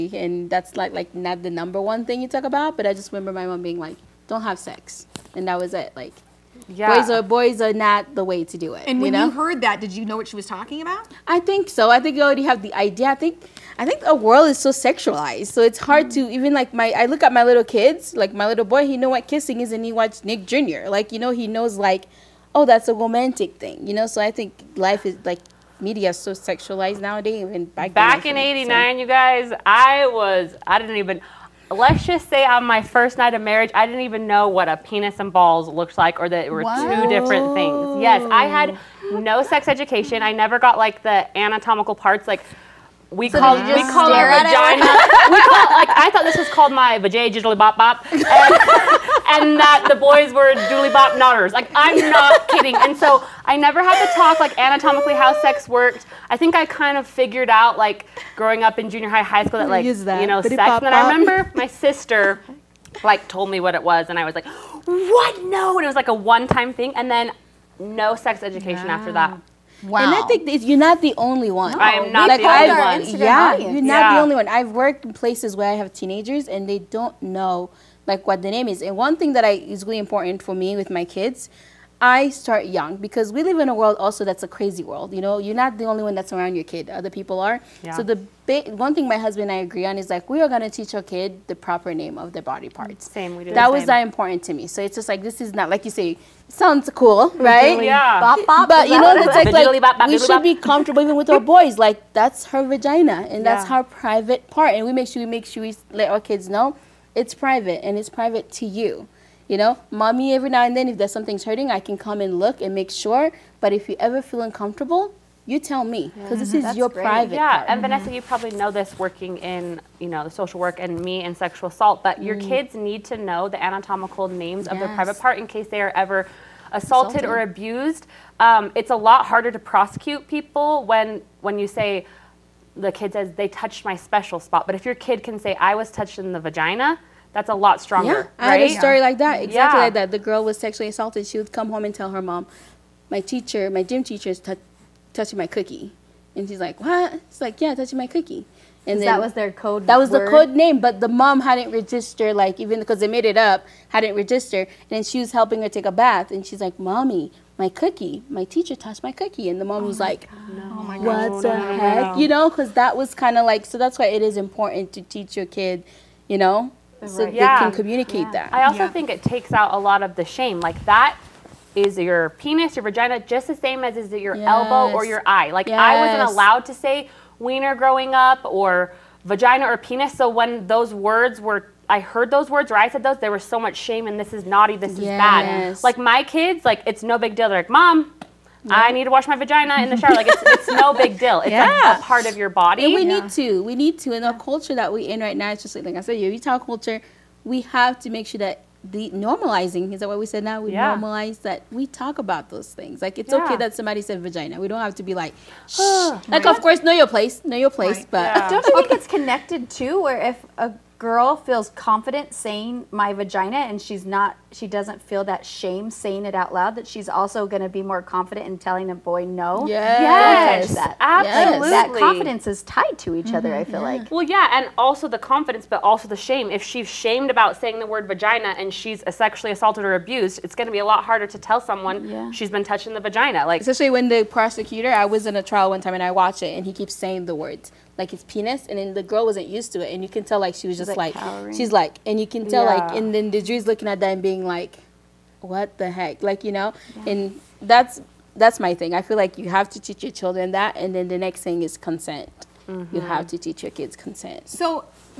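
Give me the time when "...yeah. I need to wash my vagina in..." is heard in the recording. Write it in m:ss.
3:08.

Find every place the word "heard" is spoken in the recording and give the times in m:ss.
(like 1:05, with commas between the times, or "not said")
0:09, 3:01.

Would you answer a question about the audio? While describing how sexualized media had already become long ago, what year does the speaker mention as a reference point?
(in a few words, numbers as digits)
89.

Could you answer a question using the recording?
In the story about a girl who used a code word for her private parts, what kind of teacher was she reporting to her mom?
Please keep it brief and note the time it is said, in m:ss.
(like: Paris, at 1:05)
Gym teacher, at 2:23.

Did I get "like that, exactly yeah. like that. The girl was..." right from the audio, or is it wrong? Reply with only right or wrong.
right.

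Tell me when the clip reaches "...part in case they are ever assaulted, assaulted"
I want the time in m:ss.
2:05.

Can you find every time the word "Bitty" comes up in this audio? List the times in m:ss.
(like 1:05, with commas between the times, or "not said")
1:00.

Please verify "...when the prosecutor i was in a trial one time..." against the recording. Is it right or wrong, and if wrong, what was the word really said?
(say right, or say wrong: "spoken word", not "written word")
right.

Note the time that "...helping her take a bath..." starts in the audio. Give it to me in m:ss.
2:35.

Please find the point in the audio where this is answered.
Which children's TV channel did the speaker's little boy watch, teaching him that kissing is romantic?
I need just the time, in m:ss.
0:20.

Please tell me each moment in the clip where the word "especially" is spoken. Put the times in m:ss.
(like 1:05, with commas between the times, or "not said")
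3:53.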